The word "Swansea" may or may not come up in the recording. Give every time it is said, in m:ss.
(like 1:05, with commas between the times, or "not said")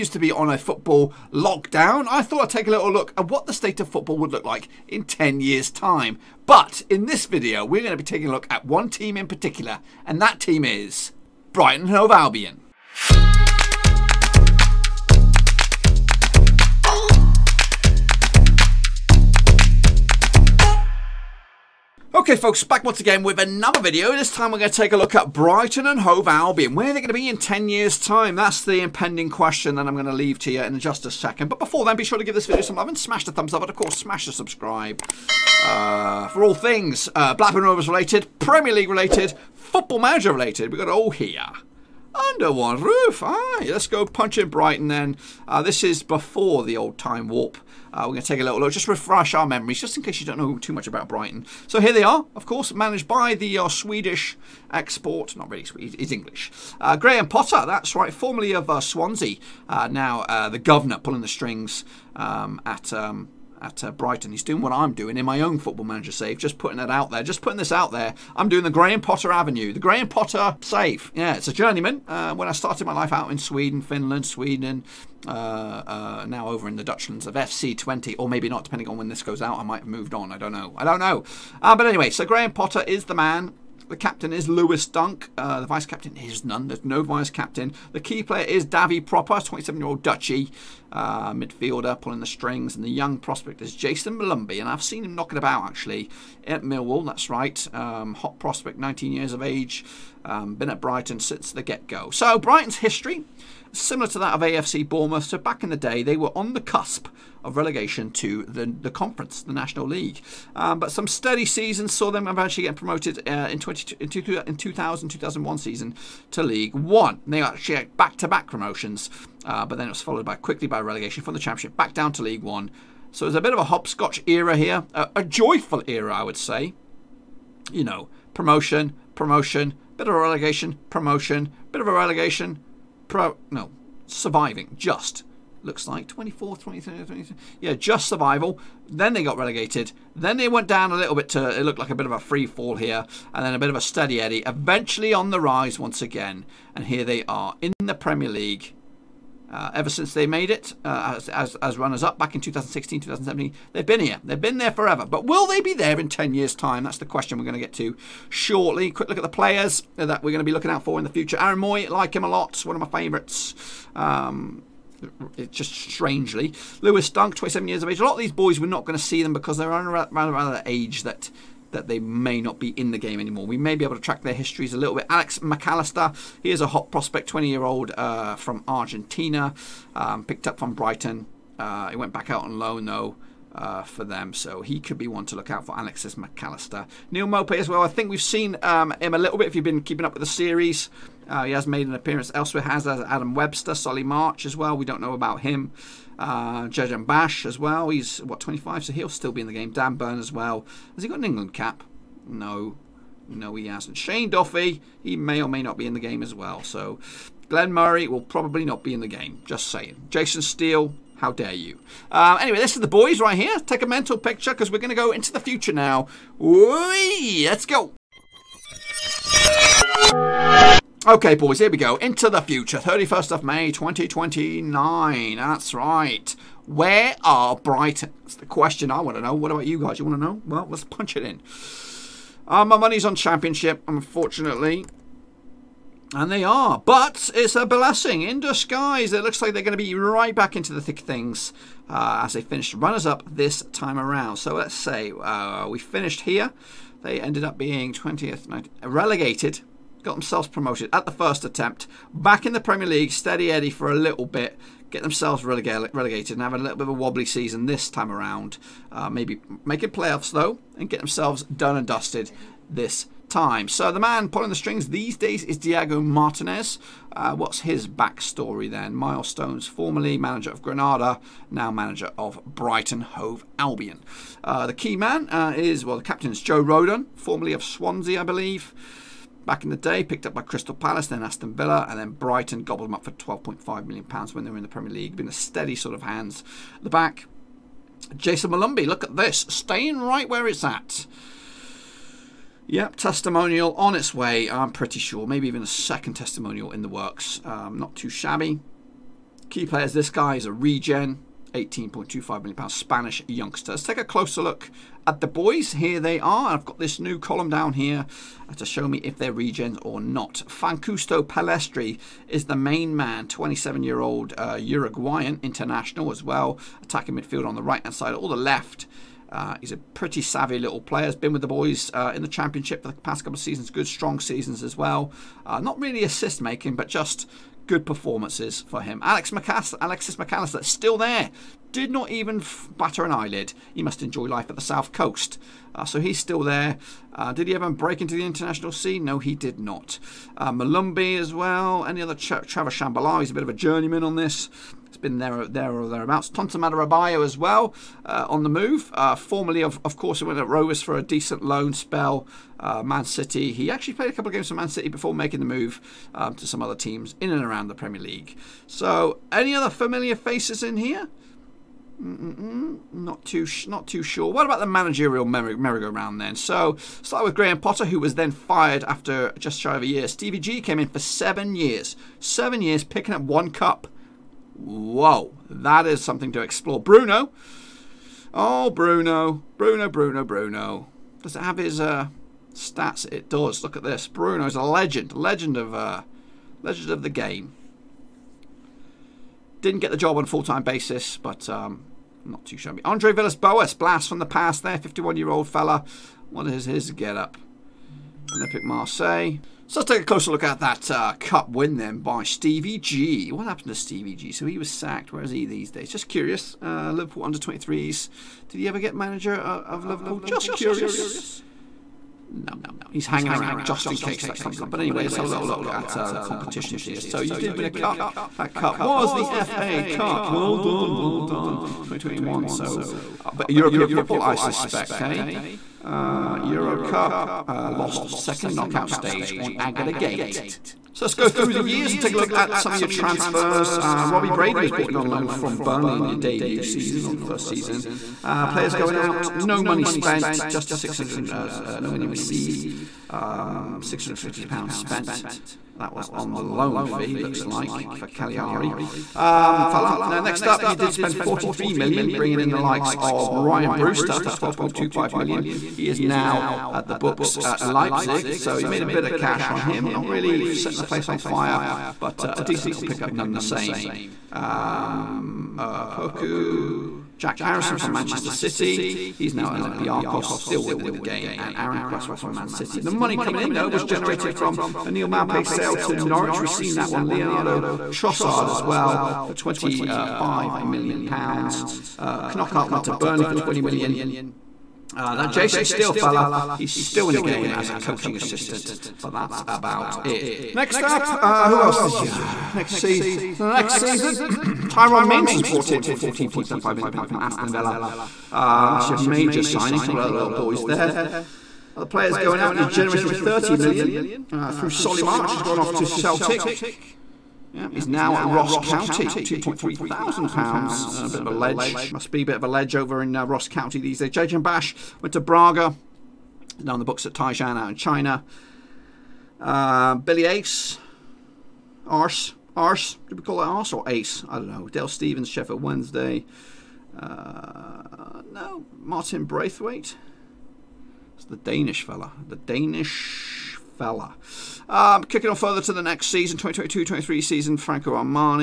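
0:58, 4:37.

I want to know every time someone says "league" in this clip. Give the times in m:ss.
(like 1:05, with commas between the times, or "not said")
0:38, 1:49, 1:56, 2:02, 2:28, 4:12, 4:44, 5:58.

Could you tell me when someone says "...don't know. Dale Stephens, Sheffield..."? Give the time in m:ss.
8:44.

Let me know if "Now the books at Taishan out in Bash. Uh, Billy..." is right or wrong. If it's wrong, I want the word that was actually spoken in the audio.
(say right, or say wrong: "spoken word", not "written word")
wrong: "China", not "Bash".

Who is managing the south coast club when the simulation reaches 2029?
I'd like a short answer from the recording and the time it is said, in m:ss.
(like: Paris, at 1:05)
Diego Martinez, at 4:25.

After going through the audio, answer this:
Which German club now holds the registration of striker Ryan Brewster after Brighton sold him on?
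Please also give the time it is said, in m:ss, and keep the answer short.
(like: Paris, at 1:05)
Leipzig, at 7:37.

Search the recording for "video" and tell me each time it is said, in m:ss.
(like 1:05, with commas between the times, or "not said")
0:07, 0:23, 0:32.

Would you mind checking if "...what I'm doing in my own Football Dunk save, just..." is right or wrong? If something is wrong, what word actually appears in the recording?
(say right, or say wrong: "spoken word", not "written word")
wrong: "Manager", not "Dunk".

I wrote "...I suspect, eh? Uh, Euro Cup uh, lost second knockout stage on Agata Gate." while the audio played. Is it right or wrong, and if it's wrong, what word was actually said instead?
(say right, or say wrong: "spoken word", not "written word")
right.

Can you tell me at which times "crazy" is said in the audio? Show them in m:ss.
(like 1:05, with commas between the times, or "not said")
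not said.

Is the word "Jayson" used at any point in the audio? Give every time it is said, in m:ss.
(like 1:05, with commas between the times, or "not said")
1:33, 4:48.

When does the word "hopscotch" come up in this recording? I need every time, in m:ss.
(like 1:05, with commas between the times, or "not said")
2:03.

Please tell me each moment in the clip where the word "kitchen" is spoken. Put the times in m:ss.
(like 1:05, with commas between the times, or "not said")
not said.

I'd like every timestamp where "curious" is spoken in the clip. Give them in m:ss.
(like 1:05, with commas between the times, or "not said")
6:46, 6:50.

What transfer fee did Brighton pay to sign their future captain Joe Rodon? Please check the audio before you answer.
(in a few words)
£12.5 million.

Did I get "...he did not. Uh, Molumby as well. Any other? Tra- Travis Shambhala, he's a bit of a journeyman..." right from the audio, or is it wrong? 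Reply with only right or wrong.
right.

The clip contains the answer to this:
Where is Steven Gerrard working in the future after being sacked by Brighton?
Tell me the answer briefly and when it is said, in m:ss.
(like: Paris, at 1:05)
Liverpool under 23s, at 6:46.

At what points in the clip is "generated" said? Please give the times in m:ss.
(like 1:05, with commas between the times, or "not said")
7:53, 8:22.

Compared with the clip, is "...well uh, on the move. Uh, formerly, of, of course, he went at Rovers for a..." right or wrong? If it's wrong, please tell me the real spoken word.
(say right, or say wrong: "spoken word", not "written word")
right.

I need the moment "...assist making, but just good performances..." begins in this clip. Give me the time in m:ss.
5:26.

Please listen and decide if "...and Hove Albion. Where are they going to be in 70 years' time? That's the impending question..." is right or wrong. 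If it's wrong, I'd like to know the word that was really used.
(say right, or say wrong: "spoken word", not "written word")
wrong: "10", not "70".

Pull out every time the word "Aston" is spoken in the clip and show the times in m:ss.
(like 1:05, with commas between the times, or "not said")
4:41, 8:17.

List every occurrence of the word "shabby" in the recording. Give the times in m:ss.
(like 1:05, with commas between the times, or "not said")
4:58, 6:32.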